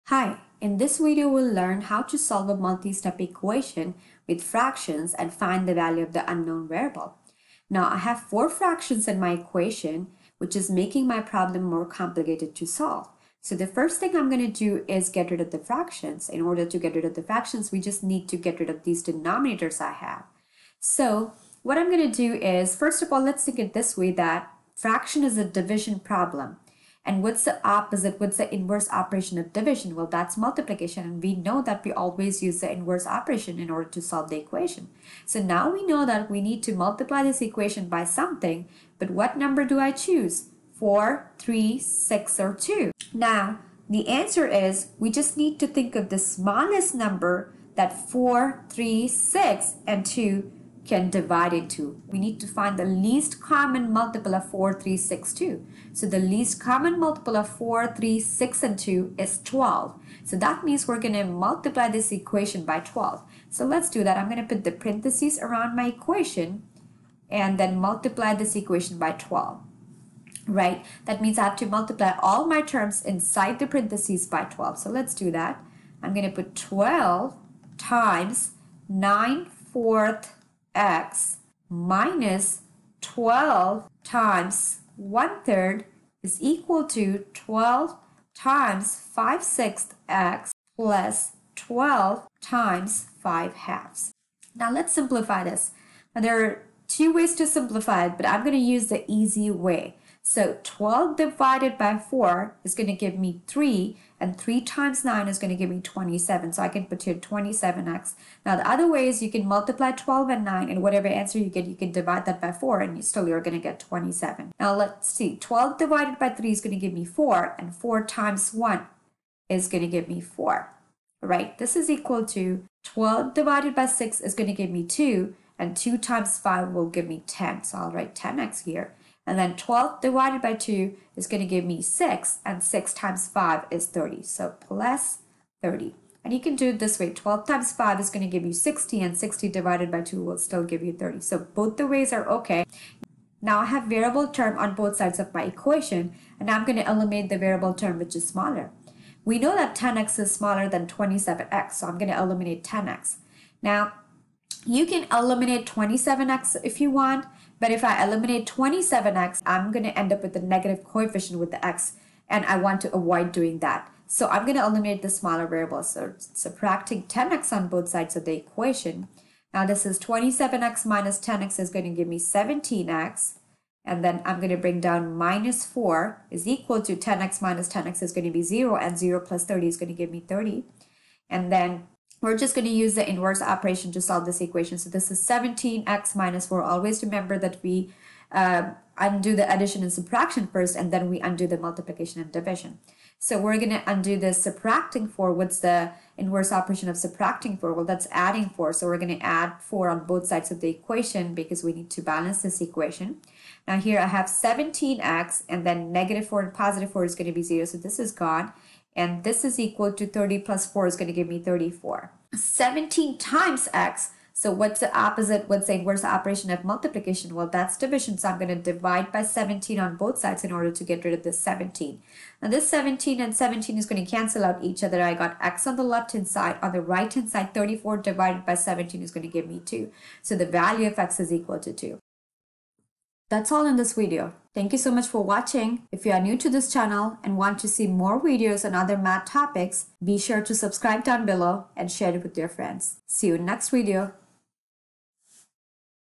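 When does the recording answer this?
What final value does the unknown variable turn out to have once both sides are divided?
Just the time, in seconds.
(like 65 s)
230 s.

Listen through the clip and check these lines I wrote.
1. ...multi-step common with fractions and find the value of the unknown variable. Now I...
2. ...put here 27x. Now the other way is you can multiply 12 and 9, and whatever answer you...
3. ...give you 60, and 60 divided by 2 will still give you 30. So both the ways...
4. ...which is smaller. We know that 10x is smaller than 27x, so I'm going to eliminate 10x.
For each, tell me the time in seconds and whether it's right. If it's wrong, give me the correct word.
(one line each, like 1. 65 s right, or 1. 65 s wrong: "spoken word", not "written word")
1. 2 s wrong: "equation", not "common"
2. 106 s right
3. 138 s right
4. 147 s right.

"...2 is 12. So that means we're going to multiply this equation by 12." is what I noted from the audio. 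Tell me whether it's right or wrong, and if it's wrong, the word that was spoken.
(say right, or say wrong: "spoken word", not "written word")
right.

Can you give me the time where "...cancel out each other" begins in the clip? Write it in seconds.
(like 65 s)
224 s.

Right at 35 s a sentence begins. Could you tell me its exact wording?
So now we know that we need to multiply this equation by something.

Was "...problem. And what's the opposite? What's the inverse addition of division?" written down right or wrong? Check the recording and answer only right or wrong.
wrong.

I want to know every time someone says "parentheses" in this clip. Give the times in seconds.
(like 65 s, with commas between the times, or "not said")
64 s, 73 s.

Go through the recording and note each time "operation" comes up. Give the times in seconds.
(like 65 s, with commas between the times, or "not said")
28 s, 33 s, 183 s, 196 s, 216 s.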